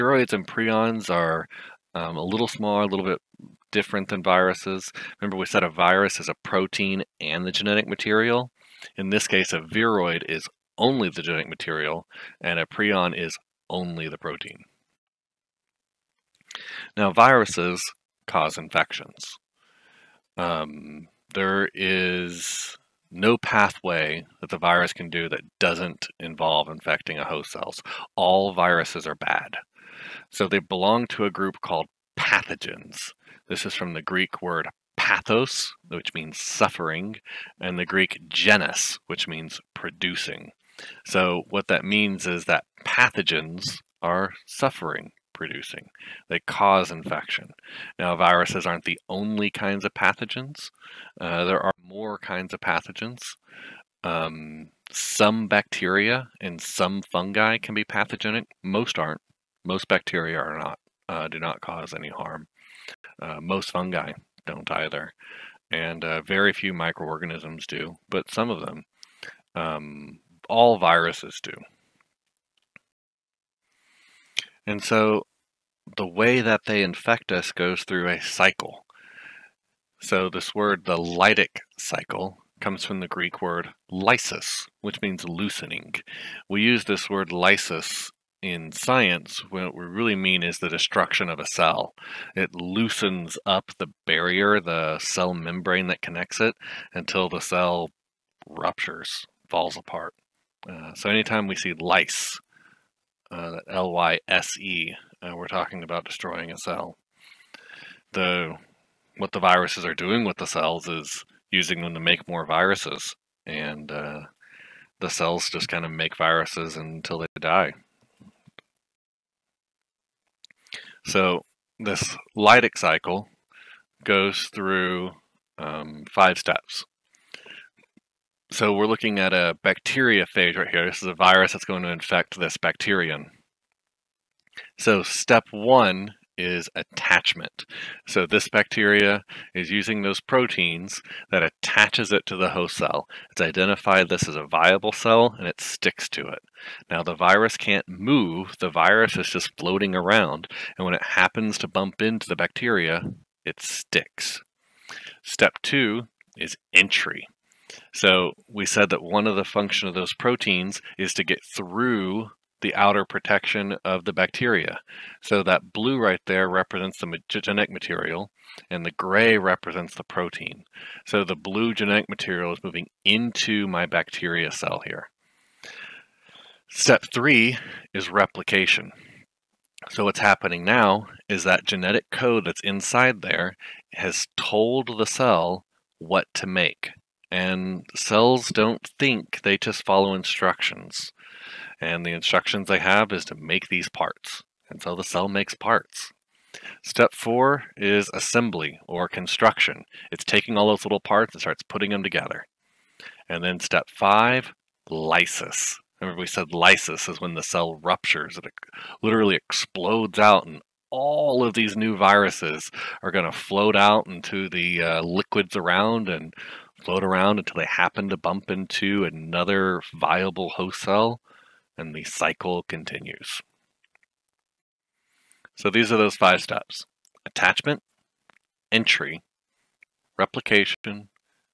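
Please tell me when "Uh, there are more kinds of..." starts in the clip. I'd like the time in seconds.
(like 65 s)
51 s.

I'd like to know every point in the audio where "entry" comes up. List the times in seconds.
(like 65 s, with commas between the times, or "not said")
156 s, 228 s.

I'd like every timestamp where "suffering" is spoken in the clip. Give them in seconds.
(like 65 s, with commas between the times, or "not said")
36 s, 44 s.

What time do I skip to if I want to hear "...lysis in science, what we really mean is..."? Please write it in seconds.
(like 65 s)
87 s.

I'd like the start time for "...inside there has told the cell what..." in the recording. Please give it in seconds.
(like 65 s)
182 s.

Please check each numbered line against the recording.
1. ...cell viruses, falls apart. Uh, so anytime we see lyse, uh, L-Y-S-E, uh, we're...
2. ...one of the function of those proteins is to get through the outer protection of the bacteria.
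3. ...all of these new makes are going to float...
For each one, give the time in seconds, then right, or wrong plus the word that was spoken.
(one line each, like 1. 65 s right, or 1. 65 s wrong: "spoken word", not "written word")
1. 97 s wrong: "ruptures", not "viruses"
2. 159 s right
3. 210 s wrong: "viruses", not "makes".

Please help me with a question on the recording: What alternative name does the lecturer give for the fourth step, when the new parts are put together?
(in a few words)
construction.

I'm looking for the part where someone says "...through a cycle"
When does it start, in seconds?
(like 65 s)
77 s.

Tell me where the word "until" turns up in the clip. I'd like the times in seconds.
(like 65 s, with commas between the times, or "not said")
96 s, 116 s, 217 s.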